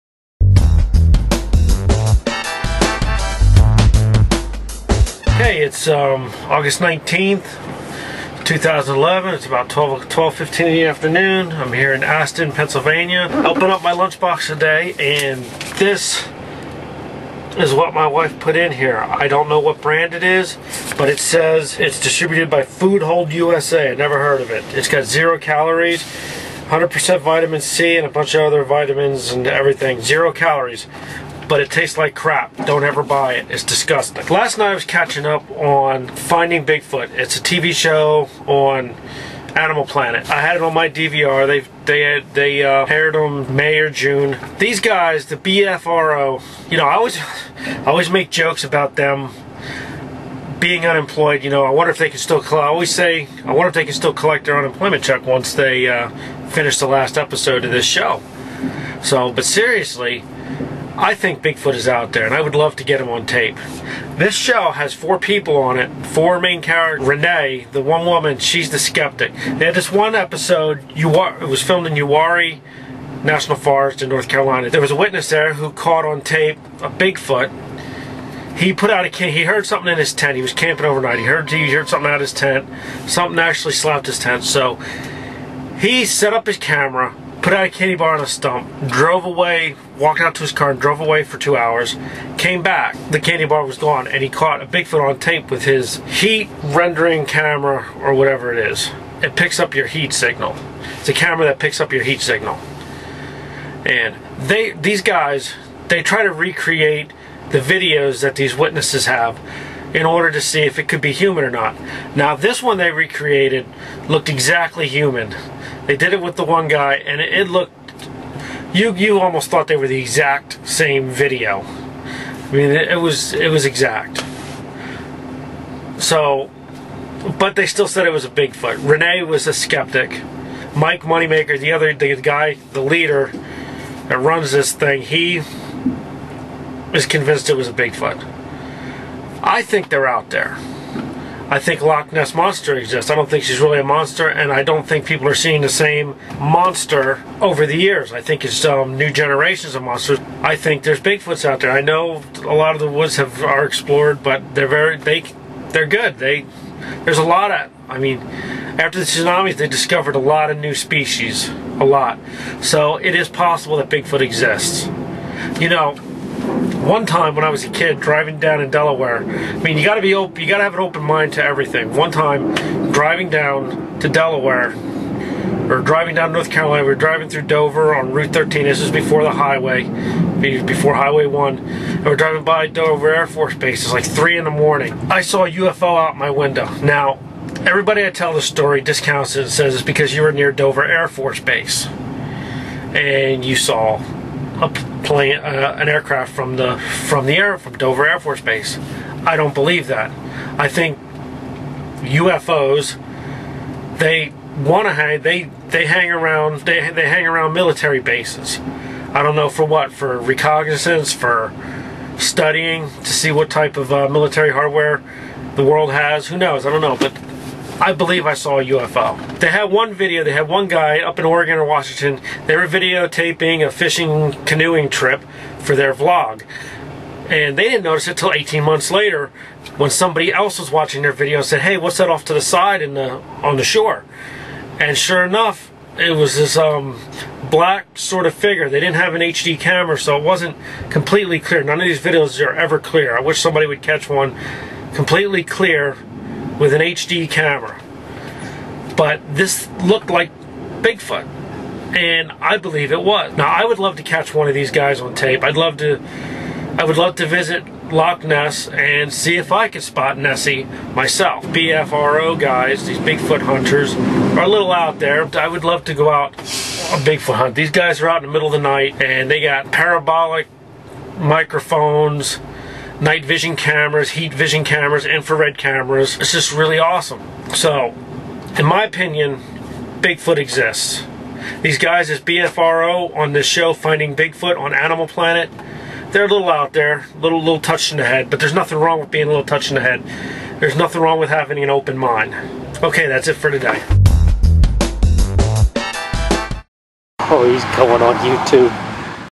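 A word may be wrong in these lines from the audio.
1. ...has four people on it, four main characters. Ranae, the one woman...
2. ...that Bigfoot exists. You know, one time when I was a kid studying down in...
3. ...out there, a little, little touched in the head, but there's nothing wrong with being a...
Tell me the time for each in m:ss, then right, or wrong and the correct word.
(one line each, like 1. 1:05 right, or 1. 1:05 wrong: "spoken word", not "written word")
1. 1:04 right
2. 2:43 wrong: "driving", not "studying"
3. 4:46 right.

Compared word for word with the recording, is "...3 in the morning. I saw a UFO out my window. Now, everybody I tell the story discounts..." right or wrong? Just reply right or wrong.
right.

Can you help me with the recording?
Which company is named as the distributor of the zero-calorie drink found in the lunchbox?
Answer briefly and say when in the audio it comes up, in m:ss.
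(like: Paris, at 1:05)
Food Hold USA, at 0:22.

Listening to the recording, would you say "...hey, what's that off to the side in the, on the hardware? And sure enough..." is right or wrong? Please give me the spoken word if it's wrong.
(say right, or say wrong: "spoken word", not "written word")
wrong: "shore", not "hardware".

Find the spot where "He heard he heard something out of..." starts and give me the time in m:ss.
1:21.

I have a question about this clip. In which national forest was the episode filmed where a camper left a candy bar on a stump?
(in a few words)
Uwharrie National Forest.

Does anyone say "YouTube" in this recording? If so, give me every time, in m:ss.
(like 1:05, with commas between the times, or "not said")
4:58.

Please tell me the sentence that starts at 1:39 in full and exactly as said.
It picks up your heat signal.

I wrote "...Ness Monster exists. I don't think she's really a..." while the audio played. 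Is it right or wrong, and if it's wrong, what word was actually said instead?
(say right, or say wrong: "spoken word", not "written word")
right.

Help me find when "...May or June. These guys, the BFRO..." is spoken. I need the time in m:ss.
0:43.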